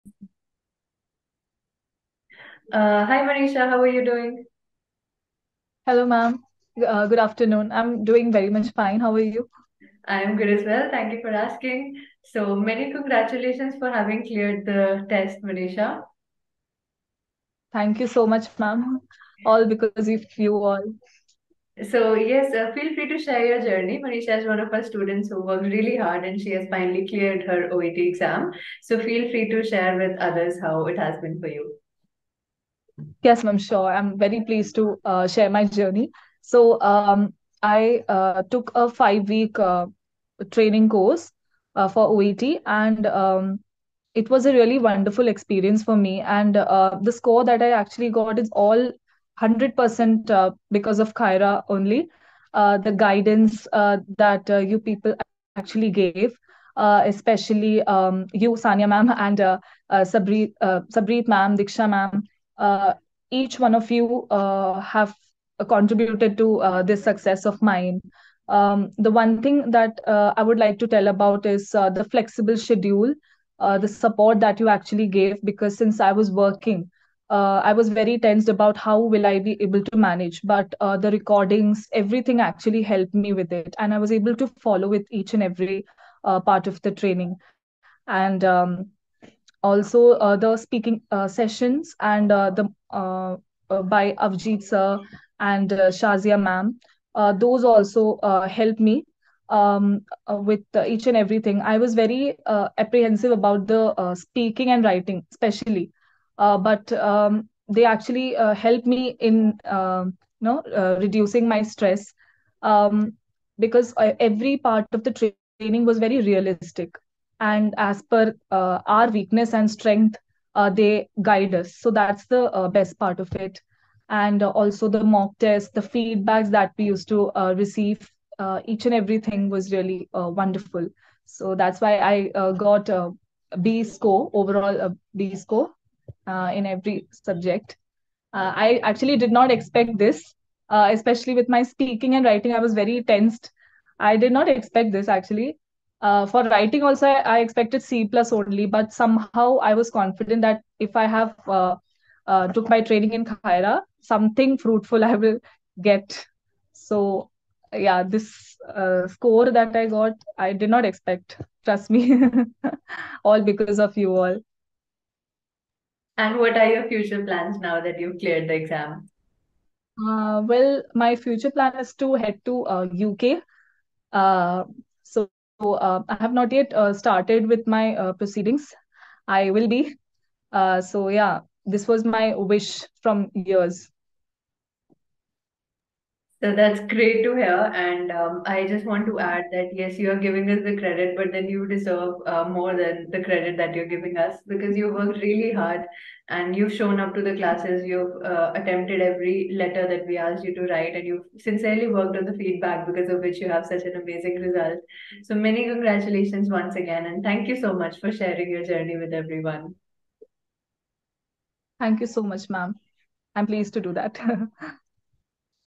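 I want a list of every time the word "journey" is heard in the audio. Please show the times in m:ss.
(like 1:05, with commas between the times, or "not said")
0:23, 0:35, 3:28.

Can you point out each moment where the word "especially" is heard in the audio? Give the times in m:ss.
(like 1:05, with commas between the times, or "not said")
0:56, 1:45, 2:20.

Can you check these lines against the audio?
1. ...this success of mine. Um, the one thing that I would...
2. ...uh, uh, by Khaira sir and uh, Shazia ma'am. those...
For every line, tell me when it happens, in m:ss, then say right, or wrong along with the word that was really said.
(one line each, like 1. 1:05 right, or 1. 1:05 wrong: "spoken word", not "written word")
1. 1:06 right
2. 1:32 wrong: "Avjit", not "Khaira".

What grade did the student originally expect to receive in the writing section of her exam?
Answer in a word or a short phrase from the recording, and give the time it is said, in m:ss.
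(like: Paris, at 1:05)
C plus, at 2:27.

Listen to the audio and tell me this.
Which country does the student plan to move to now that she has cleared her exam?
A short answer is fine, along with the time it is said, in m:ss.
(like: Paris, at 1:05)
UK, at 2:53.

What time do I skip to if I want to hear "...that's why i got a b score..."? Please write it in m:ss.
2:11.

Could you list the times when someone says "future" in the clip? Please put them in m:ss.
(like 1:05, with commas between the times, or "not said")
2:46, 2:51.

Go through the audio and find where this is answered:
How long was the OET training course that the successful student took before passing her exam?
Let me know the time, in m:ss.
0:38.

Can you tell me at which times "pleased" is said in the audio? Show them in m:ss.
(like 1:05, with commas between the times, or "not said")
0:34, 3:33.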